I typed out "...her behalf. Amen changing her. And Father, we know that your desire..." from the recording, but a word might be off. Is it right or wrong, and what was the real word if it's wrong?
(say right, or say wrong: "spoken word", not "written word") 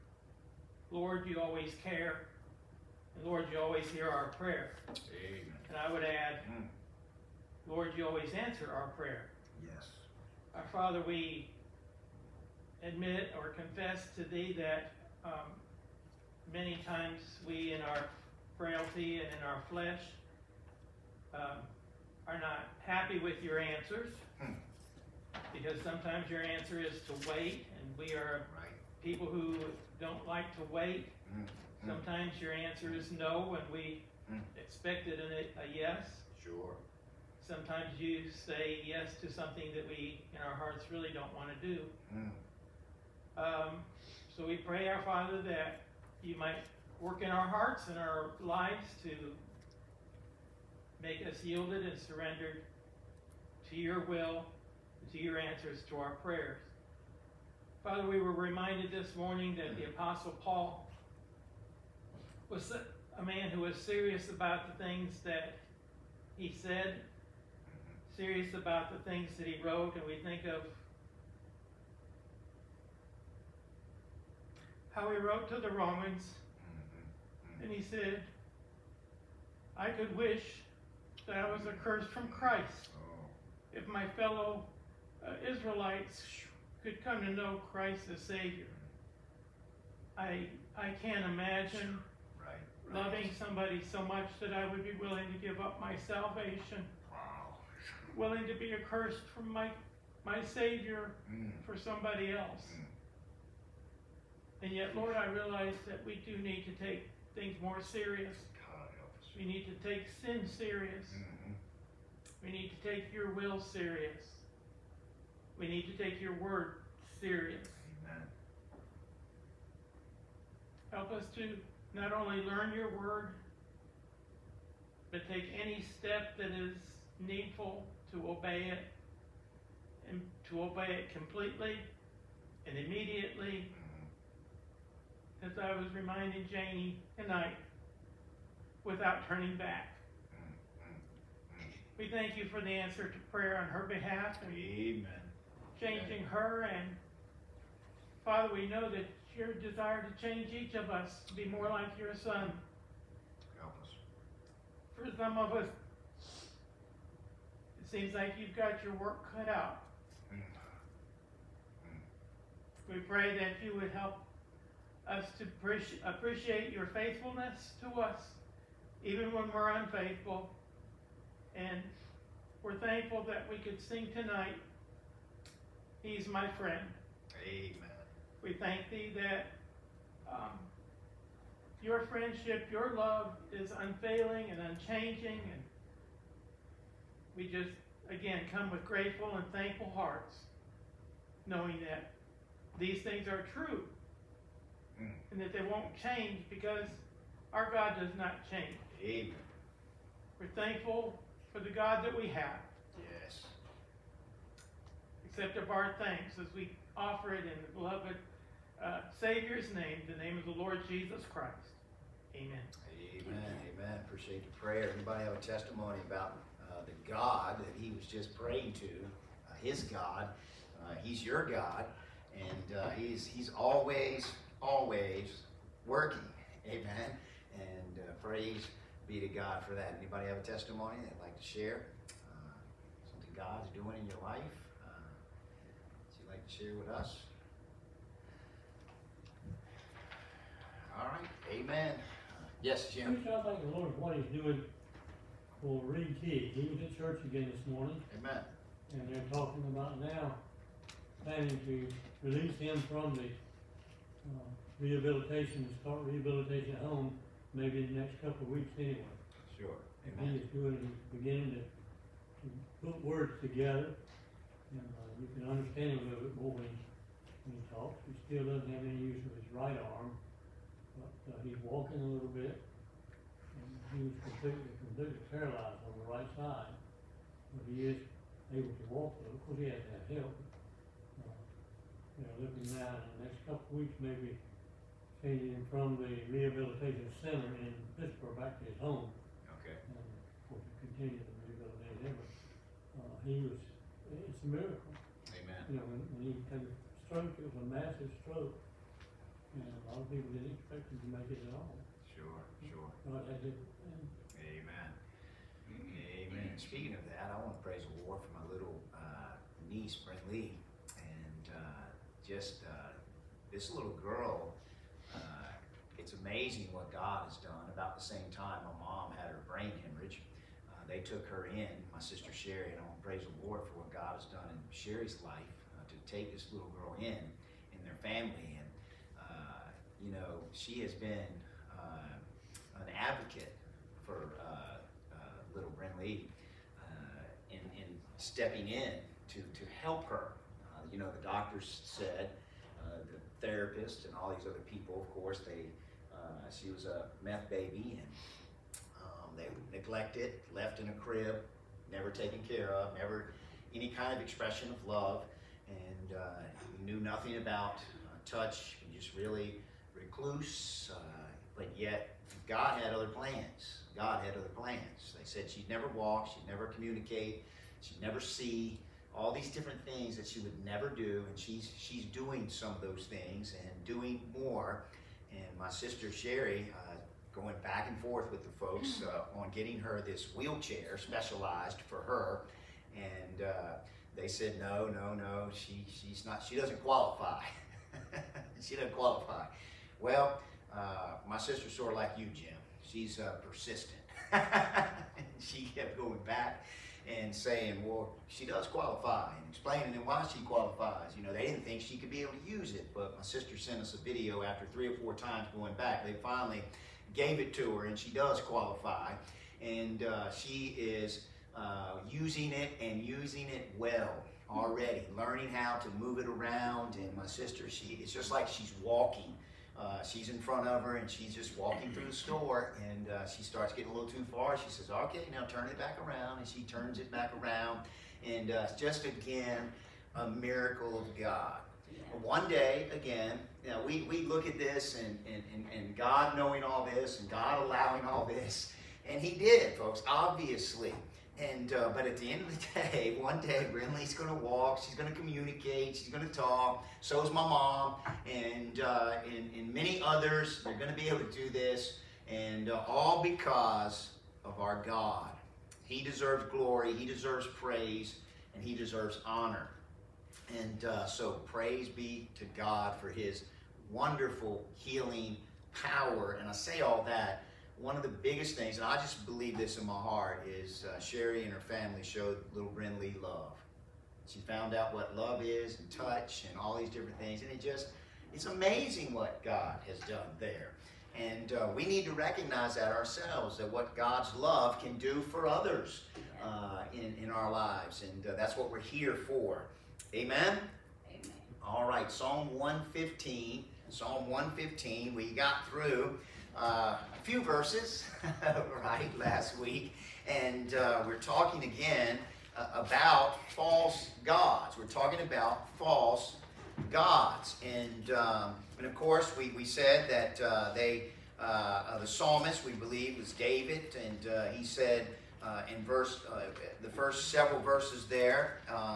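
right.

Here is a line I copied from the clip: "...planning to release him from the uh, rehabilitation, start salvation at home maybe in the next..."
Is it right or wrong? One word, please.
wrong.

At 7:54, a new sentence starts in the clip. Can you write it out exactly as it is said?
She found out what love is and touch and all these different things.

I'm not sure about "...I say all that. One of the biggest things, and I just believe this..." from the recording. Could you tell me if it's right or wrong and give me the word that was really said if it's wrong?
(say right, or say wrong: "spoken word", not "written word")
right.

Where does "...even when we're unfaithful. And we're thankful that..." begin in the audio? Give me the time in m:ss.
2:49.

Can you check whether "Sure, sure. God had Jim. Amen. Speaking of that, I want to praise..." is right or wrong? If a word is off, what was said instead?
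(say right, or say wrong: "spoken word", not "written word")
wrong: "Amen", not "Jim".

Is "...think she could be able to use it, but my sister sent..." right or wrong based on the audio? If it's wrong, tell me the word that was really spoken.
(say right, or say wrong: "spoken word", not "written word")
right.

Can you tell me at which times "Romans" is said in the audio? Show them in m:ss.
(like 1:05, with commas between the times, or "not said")
1:15.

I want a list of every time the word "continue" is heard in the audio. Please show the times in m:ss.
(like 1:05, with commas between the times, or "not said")
4:50.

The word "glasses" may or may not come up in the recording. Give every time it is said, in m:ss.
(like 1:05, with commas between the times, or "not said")
not said.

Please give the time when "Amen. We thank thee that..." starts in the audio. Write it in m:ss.
2:57.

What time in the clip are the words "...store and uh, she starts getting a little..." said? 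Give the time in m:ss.
7:02.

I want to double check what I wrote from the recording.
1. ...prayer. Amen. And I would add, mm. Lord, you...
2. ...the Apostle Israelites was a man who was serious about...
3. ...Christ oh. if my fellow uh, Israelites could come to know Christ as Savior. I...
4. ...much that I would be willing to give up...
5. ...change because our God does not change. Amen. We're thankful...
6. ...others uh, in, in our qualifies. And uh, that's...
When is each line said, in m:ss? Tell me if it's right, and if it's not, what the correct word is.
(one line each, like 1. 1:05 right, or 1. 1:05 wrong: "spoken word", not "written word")
1. 0:04 right
2. 0:59 wrong: "Paul", not "Israelites"
3. 1:22 right
4. 1:34 right
5. 3:16 right
6. 8:05 wrong: "lives", not "qualifies".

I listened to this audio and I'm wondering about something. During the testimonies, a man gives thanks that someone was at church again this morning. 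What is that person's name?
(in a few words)
Reed Key.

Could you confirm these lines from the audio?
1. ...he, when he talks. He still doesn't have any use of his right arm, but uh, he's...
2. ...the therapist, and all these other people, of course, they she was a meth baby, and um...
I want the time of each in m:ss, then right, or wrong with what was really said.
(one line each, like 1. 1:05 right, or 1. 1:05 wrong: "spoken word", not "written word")
1. 4:26 right
2. 5:43 right.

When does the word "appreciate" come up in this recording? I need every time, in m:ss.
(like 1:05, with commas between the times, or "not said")
2:46, 3:34.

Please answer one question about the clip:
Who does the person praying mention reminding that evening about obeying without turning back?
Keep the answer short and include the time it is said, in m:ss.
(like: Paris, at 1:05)
Janie, at 2:16.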